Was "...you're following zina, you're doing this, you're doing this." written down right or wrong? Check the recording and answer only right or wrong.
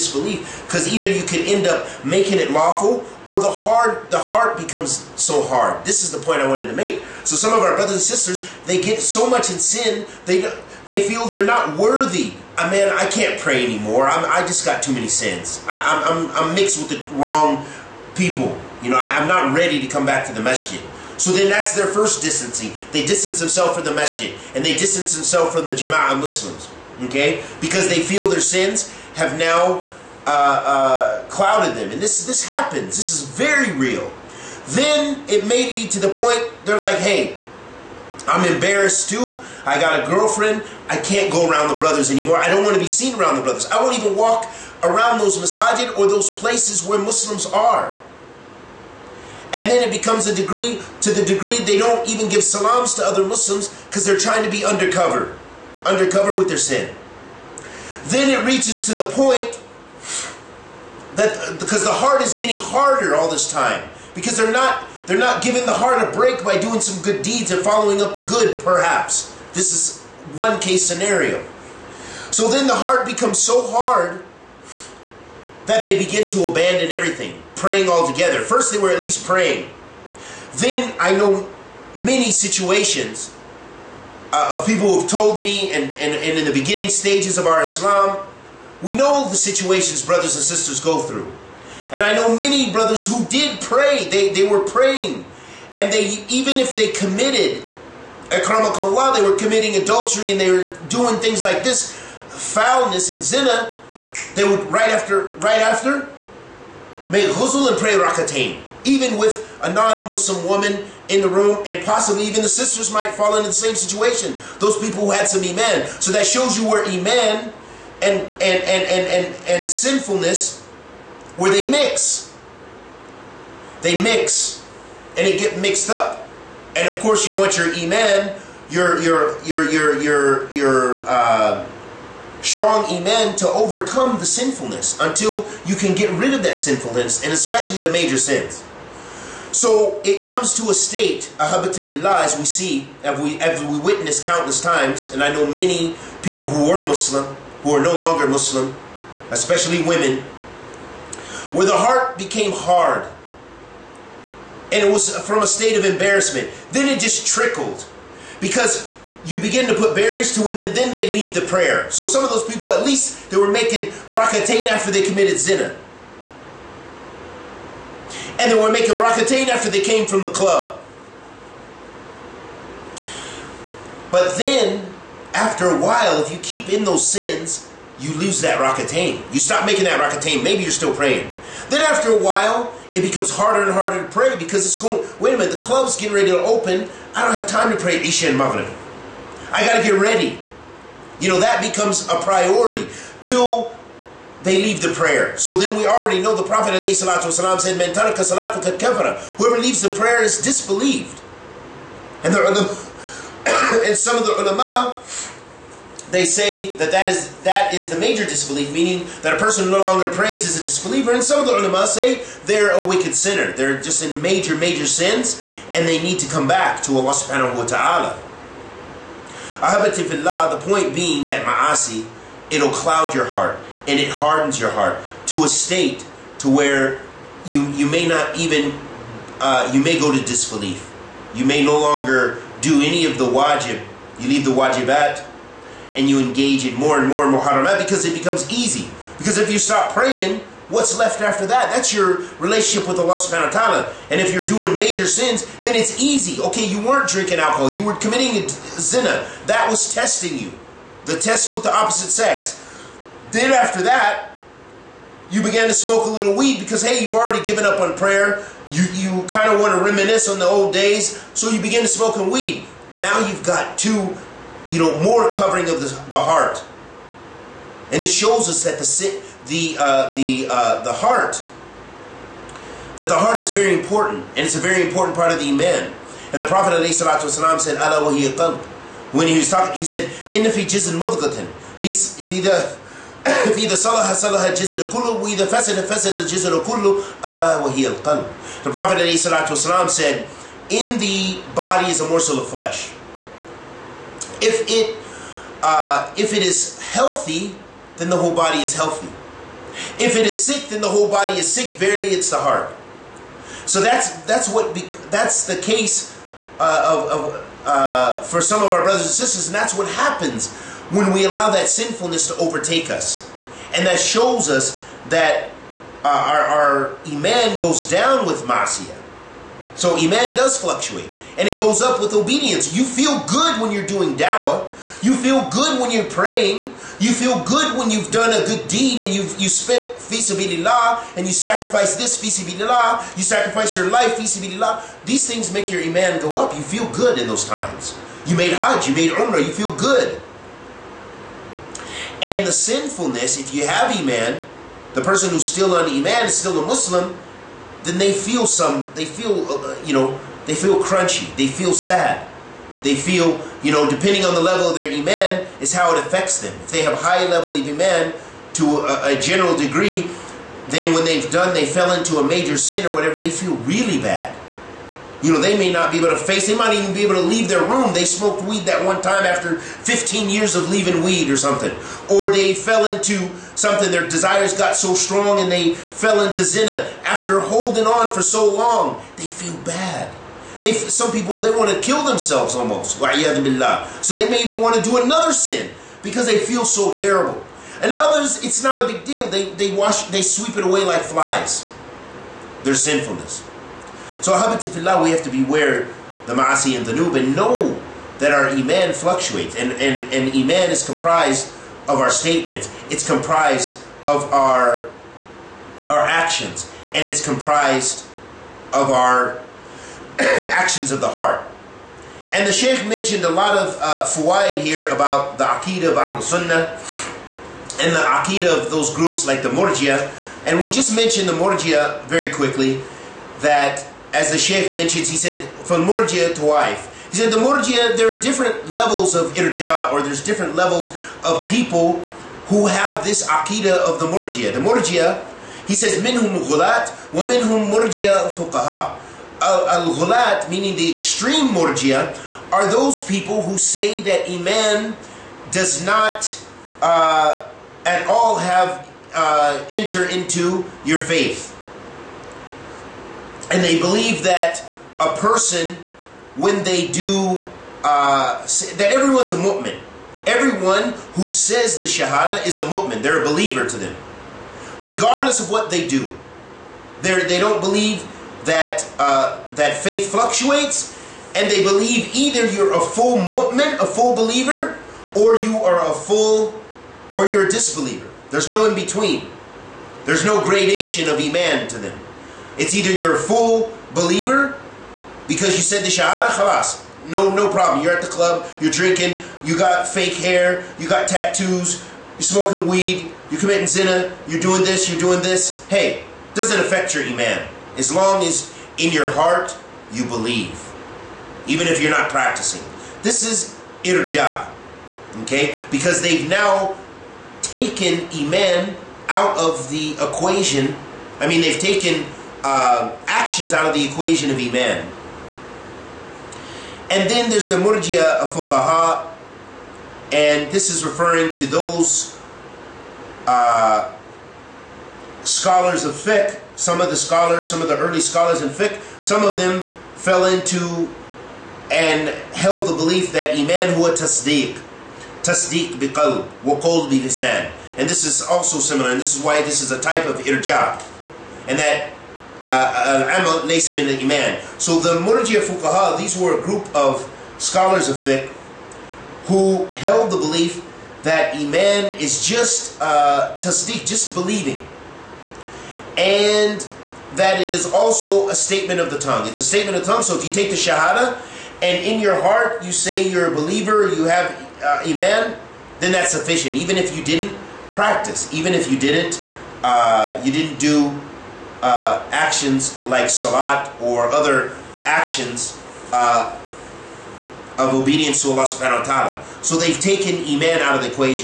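wrong.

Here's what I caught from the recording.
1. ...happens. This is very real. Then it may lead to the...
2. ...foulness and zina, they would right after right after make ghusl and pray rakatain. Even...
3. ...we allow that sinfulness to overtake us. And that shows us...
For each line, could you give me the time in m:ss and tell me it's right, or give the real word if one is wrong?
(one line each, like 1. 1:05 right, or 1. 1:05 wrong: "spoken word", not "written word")
1. 0:32 right
2. 1:42 right
3. 5:11 right.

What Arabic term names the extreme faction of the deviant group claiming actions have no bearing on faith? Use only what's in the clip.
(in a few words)
al-ghulat.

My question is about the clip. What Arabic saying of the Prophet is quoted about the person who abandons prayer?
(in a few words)
Man taraka kafara.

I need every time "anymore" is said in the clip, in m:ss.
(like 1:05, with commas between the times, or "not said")
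0:13, 0:42.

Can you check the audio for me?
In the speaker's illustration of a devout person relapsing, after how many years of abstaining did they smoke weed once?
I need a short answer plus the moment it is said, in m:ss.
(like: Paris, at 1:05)
15, at 6:09.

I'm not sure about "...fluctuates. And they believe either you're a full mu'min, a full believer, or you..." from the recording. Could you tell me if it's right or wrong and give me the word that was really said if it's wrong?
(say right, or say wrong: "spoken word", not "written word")
right.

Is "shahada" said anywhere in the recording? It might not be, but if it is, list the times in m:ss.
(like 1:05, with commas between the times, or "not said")
7:41, 8:05, 9:20.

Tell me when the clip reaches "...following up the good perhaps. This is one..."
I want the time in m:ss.
1:07.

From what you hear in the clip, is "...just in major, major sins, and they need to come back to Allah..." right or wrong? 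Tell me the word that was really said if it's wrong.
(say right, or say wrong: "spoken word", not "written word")
right.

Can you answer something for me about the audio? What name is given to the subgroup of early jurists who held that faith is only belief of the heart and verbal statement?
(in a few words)
Murjia Fuqaha.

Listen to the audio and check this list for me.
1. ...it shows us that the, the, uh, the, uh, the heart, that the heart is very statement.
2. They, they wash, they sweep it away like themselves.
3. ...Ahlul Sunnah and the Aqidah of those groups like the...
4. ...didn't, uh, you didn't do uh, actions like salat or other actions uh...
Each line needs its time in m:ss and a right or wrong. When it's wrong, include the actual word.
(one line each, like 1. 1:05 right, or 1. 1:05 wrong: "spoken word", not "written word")
1. 4:28 wrong: "important", not "statement"
2. 6:29 wrong: "flies", not "themselves"
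3. 6:55 right
4. 9:28 right.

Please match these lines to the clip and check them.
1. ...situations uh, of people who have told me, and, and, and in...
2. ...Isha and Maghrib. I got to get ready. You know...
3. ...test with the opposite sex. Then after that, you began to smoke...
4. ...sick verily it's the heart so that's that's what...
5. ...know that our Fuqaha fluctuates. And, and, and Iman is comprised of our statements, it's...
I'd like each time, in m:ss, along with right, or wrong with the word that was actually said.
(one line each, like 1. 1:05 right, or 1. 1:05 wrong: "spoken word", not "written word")
1. 1:22 right
2. 3:07 right
3. 4:11 right
4. 5:01 right
5. 6:37 wrong: "Iman", not "Fuqaha".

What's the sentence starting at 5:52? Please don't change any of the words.
They feel, you know, depending on the level of their Iman, is how it affects them.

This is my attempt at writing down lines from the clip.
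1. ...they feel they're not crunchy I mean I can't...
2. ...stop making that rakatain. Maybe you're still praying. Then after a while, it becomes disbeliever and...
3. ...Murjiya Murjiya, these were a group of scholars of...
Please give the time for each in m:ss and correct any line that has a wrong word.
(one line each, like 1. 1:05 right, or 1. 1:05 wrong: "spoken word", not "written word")
1. 0:10 wrong: "worthy", not "crunchy"
2. 2:59 wrong: "harder", not "disbeliever"
3. 9:04 wrong: "Fuqaha", not "Murjiya".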